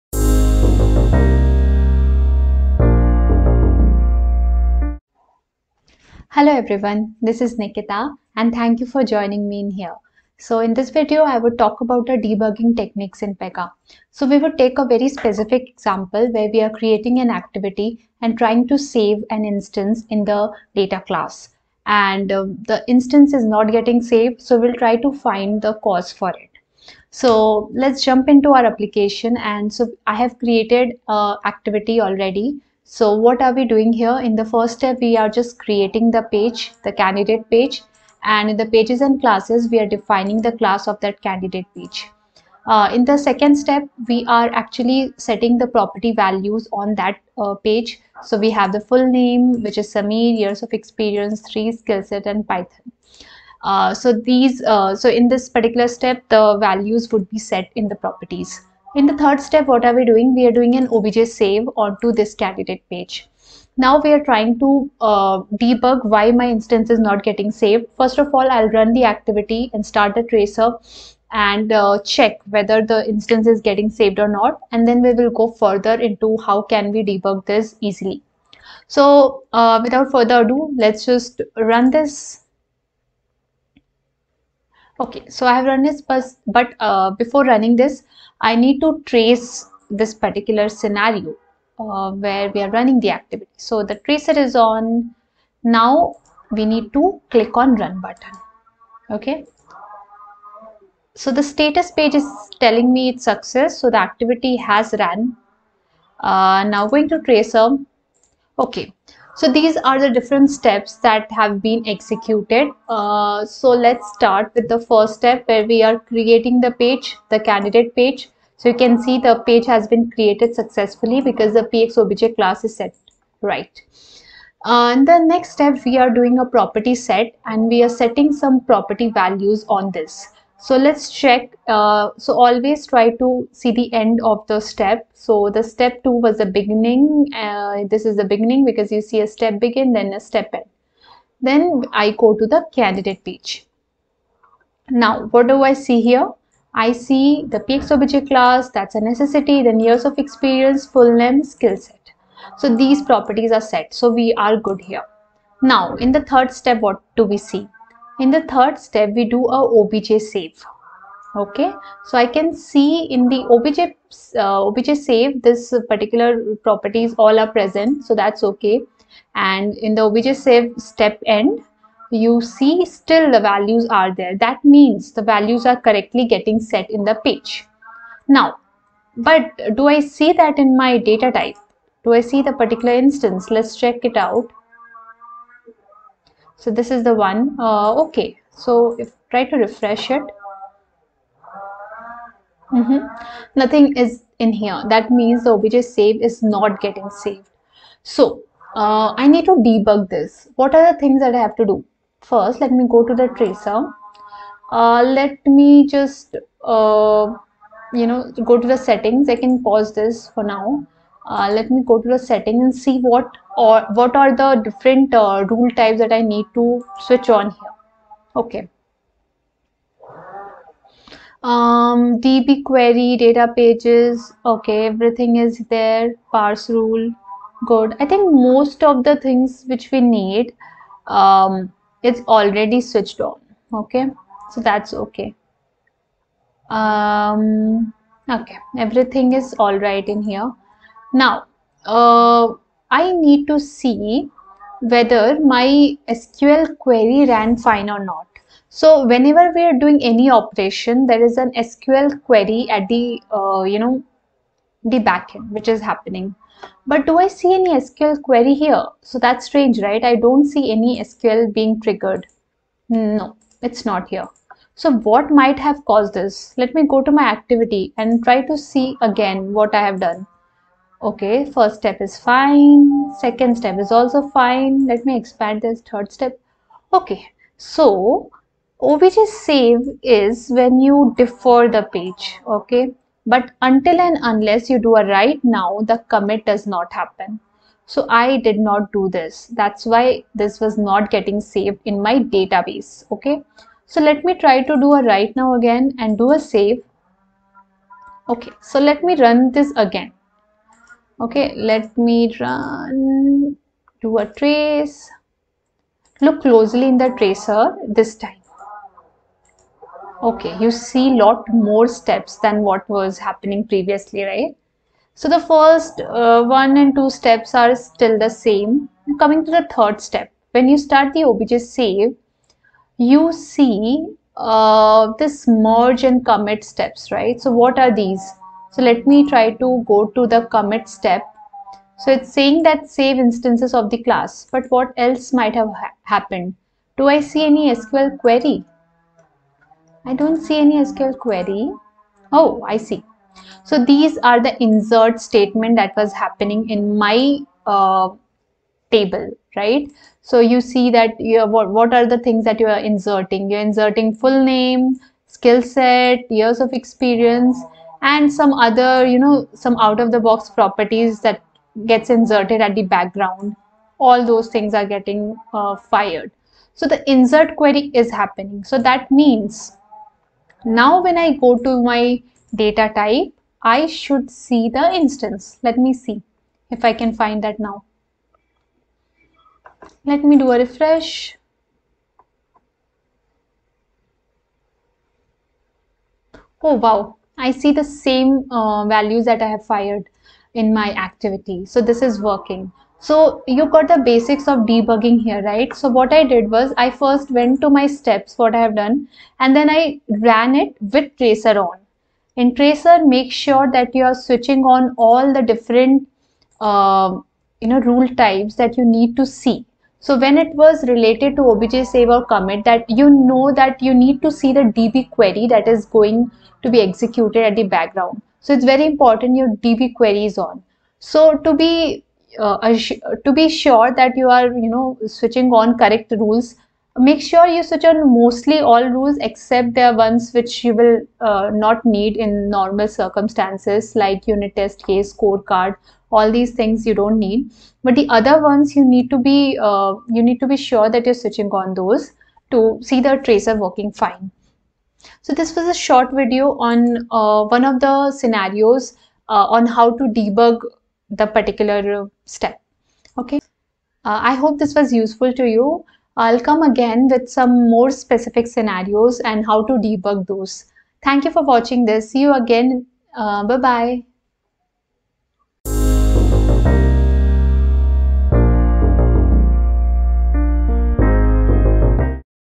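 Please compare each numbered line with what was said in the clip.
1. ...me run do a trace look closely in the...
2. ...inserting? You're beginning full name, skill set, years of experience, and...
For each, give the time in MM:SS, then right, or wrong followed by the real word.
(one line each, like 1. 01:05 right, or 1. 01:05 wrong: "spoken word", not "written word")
1. 05:02 right
2. 05:52 wrong: "inserting", not "beginning".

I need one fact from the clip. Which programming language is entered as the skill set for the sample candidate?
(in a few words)
Python.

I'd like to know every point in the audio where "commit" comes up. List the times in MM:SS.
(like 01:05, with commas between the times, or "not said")
04:46, 05:26, 05:30, 06:52.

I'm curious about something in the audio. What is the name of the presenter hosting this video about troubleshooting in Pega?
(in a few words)
Nikita.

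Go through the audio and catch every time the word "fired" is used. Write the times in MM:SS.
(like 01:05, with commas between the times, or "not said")
06:05, 06:29.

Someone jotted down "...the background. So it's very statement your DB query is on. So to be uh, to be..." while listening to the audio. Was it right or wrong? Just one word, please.
wrong.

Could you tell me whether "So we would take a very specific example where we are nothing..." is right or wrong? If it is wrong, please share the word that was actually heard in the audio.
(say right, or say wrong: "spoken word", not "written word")
wrong: "creating", not "nothing".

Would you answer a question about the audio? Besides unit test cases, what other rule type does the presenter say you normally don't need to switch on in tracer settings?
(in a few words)
scorecard.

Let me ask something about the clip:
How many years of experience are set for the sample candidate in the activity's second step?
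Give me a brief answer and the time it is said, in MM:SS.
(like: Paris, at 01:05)
3, at 00:51.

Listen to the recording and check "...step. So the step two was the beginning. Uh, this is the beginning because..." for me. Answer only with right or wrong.
right.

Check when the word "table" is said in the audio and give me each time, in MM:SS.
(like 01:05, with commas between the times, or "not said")
05:48.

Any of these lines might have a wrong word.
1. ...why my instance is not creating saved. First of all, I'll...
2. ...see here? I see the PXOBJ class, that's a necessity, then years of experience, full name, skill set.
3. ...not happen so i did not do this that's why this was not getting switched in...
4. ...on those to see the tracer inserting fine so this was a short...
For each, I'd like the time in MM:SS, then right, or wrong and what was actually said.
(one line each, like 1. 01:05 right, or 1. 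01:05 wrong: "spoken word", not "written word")
1. 01:06 wrong: "getting", not "creating"
2. 02:25 right
3. 04:46 wrong: "saved", not "switched"
4. 07:21 wrong: "working", not "inserting".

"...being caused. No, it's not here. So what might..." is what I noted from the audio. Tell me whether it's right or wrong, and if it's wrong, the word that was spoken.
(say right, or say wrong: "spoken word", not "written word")
wrong: "triggered", not "caused".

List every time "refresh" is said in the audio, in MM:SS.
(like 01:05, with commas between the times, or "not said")
03:09, 06:20.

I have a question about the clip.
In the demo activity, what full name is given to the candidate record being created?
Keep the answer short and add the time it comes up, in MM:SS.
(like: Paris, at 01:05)
Samir, at 00:49.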